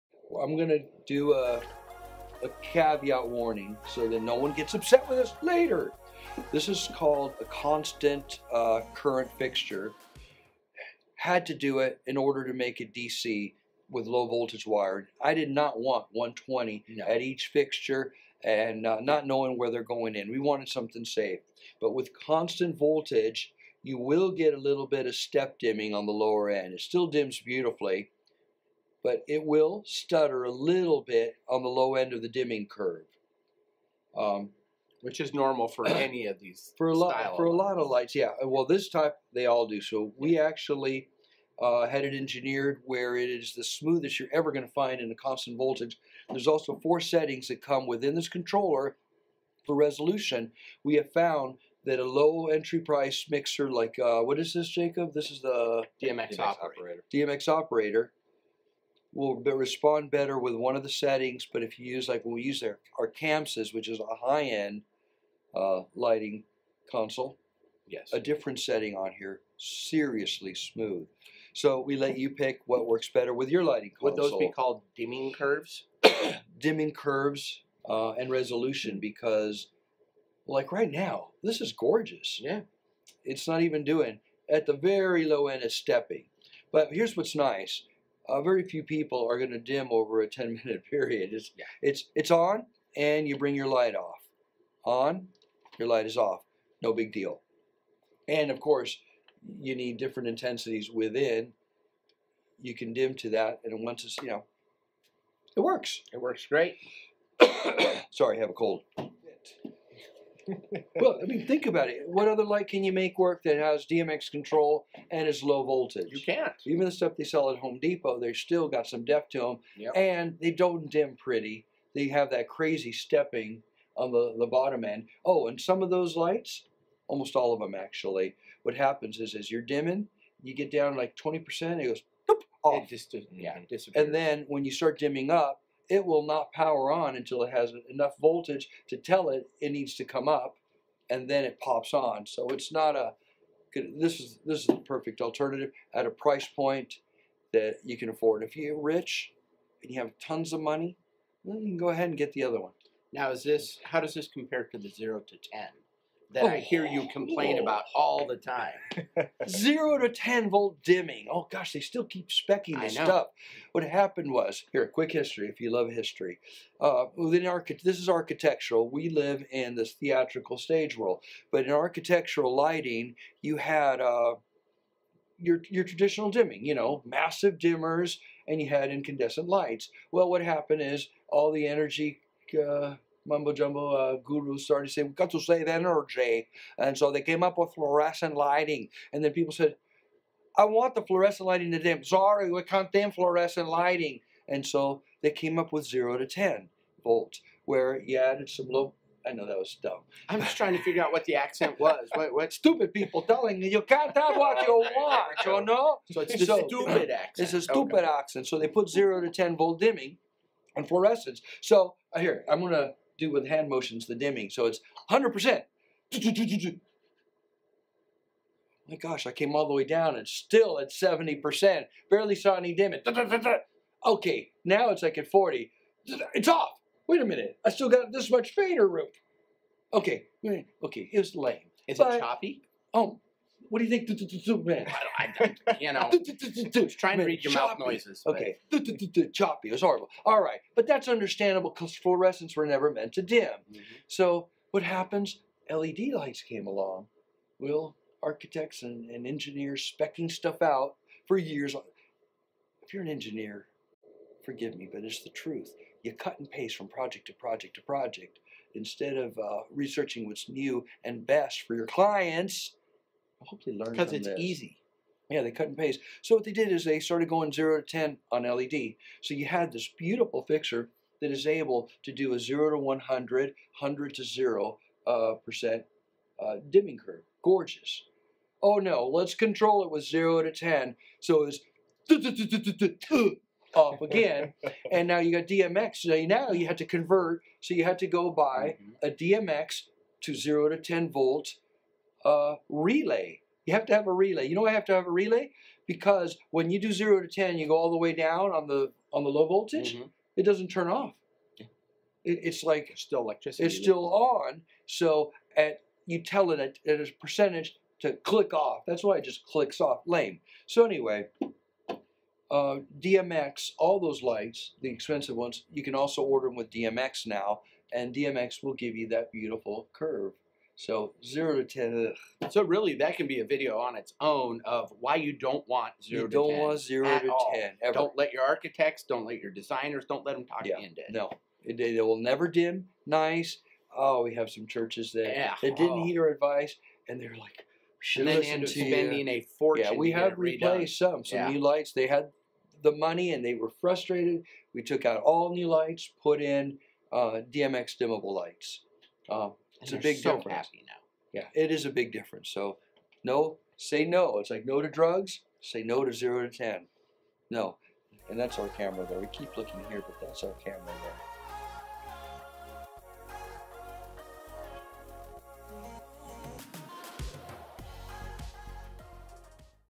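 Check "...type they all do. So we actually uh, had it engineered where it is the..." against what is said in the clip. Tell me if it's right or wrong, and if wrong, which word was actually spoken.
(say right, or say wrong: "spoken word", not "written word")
right.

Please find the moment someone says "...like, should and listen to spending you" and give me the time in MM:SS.
05:37.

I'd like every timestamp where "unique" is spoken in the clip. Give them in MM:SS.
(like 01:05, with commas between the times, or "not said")
not said.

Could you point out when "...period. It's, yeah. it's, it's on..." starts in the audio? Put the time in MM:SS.
01:30.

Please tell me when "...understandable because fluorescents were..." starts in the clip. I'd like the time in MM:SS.
04:01.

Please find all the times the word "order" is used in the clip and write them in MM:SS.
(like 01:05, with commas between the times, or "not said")
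00:12, 05:16.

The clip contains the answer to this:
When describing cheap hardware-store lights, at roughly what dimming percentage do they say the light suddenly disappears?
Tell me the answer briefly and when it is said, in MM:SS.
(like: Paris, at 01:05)
20%, at 02:11.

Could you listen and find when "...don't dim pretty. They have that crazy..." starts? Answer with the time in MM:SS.
02:00.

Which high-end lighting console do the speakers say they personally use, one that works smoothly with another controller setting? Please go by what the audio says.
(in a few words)
ChamSys.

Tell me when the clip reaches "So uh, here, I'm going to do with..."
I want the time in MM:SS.
03:31.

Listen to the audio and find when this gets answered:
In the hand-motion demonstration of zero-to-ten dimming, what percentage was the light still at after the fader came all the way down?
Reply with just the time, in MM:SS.
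03:40.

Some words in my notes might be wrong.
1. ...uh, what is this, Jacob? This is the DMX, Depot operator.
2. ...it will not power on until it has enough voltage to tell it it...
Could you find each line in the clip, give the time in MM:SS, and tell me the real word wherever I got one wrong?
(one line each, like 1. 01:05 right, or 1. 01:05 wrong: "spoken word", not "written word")
1. 00:53 wrong: "DMX", not "Depot"
2. 02:15 right.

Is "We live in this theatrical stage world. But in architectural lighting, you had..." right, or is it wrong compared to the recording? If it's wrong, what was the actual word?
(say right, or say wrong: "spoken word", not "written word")
right.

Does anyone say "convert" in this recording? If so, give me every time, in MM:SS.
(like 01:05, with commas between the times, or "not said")
04:46.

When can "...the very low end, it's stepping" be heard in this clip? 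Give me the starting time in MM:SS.
01:24.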